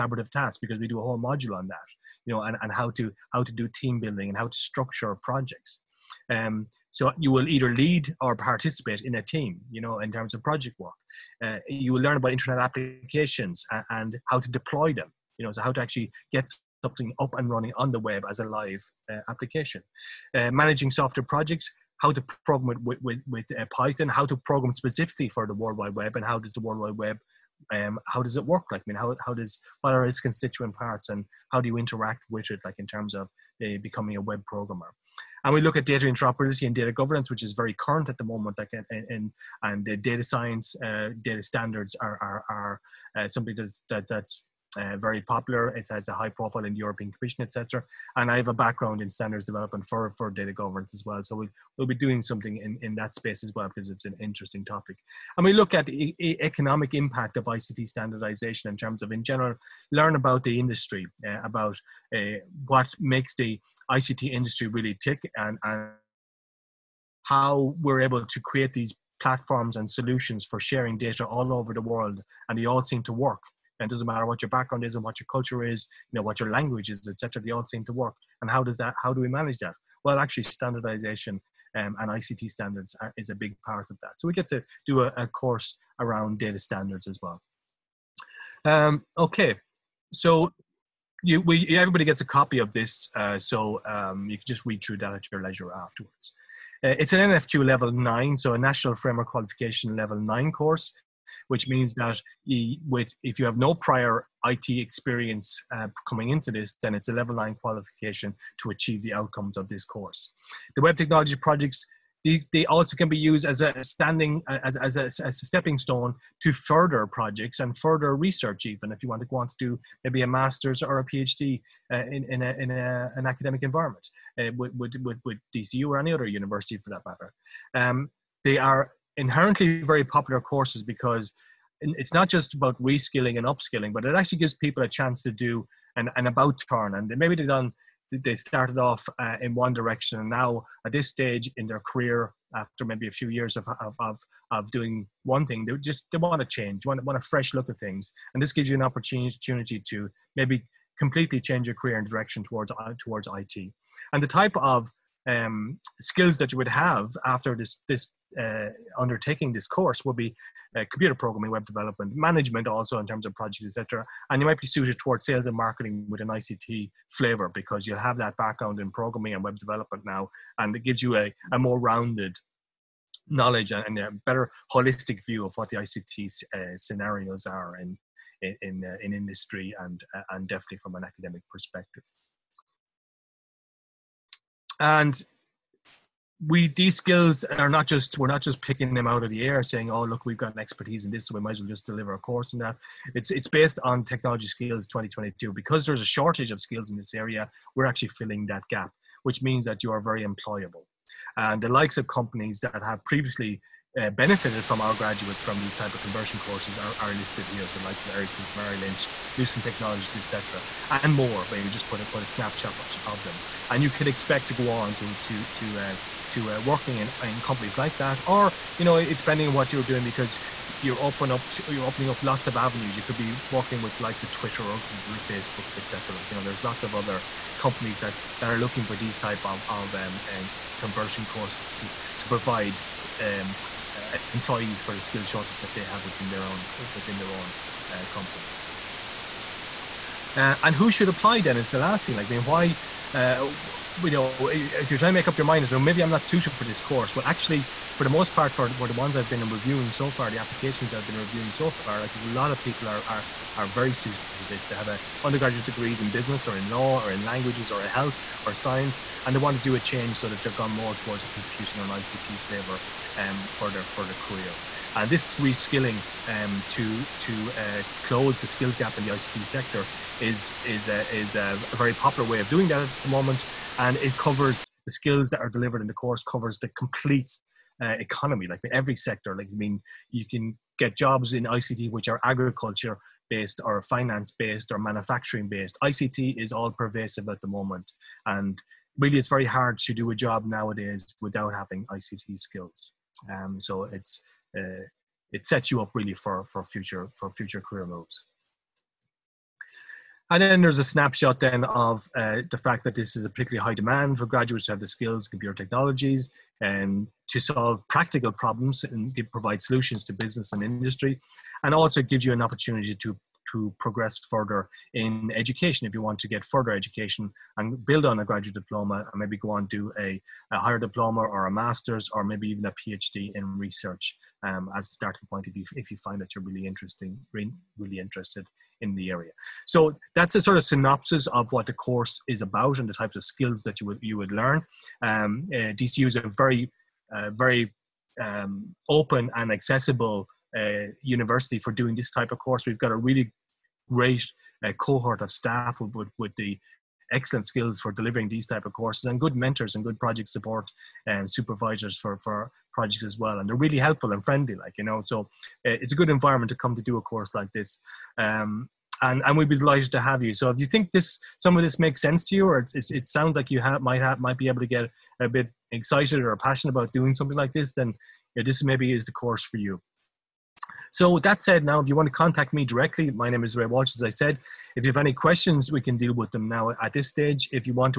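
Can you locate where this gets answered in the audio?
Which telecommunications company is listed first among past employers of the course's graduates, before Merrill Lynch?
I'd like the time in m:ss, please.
3:28.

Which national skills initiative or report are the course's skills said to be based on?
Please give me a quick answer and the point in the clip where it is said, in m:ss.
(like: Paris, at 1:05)
Technology Skills 2022, at 3:14.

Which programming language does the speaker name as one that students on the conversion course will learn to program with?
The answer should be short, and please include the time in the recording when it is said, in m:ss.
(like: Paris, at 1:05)
Python, at 0:23.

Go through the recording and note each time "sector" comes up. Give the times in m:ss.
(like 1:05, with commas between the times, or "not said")
4:29, 4:38.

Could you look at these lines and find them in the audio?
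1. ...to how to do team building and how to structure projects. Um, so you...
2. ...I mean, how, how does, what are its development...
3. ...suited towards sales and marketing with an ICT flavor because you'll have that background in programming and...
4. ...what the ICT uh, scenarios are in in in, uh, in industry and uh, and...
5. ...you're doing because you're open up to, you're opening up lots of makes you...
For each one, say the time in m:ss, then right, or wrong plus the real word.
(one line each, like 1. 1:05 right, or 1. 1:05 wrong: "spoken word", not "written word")
1. 0:02 right
2. 0:28 wrong: "constituent", not "development"
3. 2:44 right
4. 2:55 right
5. 3:39 wrong: "avenues", not "makes".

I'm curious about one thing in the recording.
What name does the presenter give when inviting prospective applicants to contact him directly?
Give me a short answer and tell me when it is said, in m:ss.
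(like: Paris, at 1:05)
Ray Walsh, at 6:13.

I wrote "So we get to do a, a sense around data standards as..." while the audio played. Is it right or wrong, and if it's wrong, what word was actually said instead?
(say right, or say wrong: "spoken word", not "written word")
wrong: "course", not "sense".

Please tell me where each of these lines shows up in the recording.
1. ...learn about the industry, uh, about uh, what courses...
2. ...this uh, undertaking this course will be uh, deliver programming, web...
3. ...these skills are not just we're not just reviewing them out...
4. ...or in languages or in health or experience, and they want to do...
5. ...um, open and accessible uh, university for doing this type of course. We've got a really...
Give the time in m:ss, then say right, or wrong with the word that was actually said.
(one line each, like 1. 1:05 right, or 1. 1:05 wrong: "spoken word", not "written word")
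1. 0:59 wrong: "makes", not "courses"
2. 2:37 wrong: "computer", not "deliver"
3. 3:06 wrong: "picking", not "reviewing"
4. 4:16 wrong: "science", not "experience"
5. 5:38 right.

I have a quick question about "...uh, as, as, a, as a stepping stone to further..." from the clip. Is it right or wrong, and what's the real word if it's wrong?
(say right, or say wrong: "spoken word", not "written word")
right.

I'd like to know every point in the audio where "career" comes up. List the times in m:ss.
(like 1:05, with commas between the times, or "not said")
2:21, 2:31, 4:24, 4:57.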